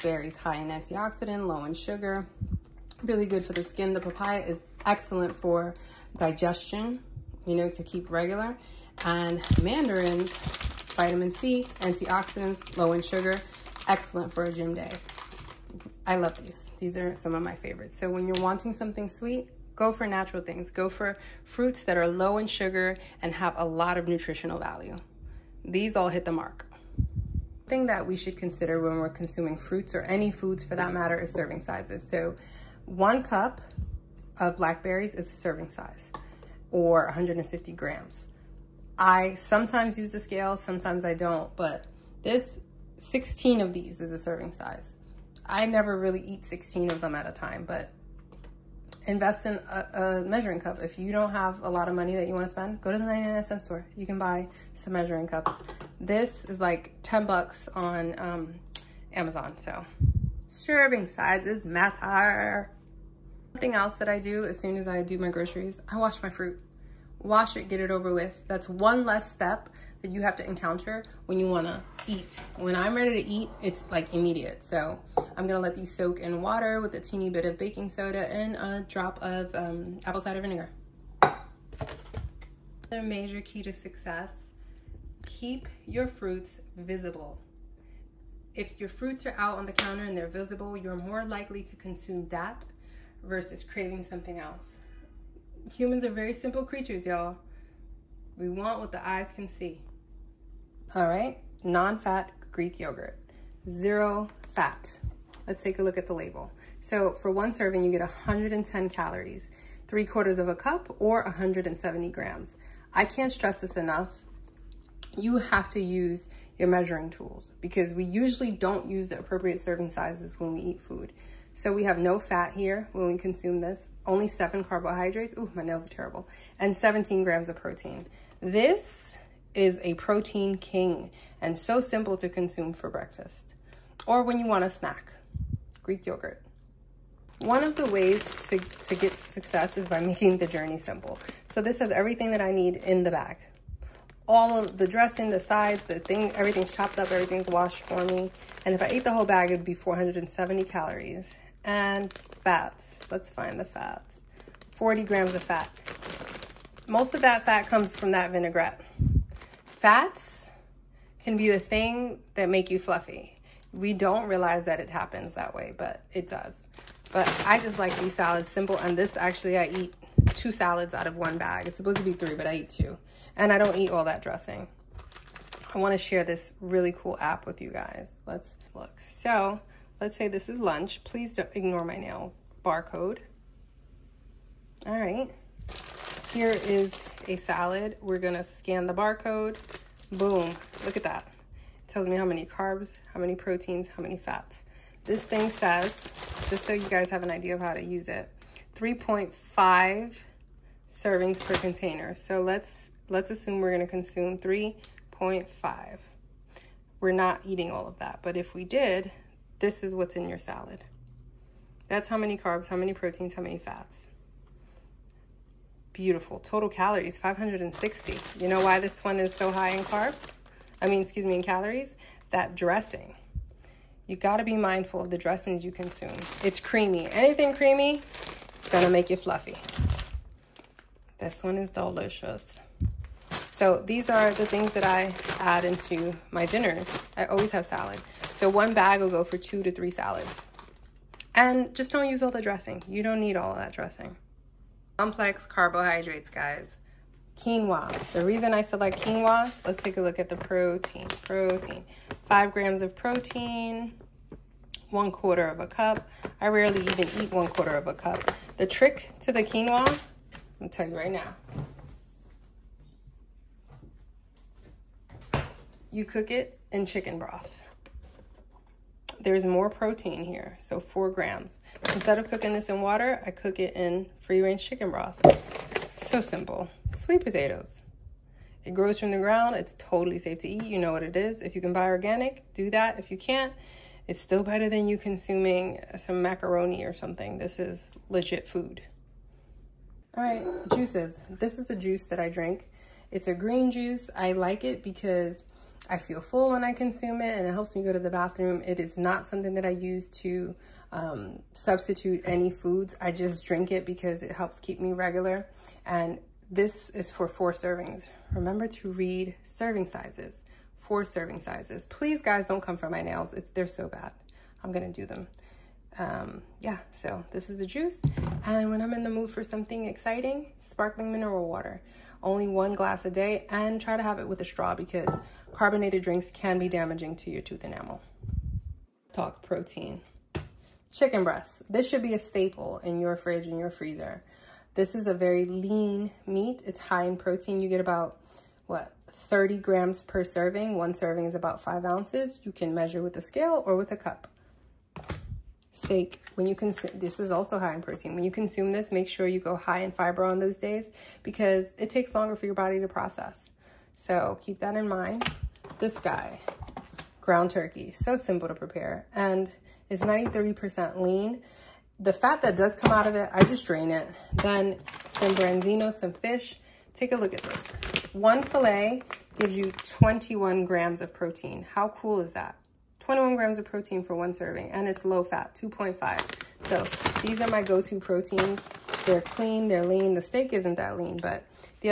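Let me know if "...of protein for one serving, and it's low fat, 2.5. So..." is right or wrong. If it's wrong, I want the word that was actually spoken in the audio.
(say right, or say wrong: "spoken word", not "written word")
right.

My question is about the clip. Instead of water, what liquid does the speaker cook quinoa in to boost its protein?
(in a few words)
free range chicken broth.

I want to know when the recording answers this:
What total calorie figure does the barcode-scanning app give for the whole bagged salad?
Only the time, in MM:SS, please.
03:37.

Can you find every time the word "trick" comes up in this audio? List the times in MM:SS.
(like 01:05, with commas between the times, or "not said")
04:18.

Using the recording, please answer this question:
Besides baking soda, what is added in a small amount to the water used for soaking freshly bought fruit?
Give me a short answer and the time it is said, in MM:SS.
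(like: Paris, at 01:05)
apple cider vinegar, at 01:20.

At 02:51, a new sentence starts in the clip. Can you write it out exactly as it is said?
It's supposed to be three, but I eat two.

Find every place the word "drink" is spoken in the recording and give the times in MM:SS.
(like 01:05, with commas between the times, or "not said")
04:52, 05:03, 05:26.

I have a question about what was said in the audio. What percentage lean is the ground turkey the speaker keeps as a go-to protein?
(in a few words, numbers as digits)
93 percent.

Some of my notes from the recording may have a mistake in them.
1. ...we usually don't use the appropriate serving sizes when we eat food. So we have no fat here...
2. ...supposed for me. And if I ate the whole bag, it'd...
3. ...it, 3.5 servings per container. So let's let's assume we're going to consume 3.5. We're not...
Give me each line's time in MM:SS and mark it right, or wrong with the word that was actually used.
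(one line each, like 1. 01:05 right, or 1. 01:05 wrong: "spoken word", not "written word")
1. 01:57 right
2. 02:27 wrong: "washed", not "supposed"
3. 03:18 right.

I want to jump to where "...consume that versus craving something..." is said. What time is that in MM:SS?
01:31.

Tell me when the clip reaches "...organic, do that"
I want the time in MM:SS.
04:41.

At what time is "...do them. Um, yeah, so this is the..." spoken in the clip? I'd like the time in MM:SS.
05:14.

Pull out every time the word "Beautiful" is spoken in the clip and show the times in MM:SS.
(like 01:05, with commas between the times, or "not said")
03:35.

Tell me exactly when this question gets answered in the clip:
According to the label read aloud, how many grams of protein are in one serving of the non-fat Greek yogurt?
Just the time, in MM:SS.
02:06.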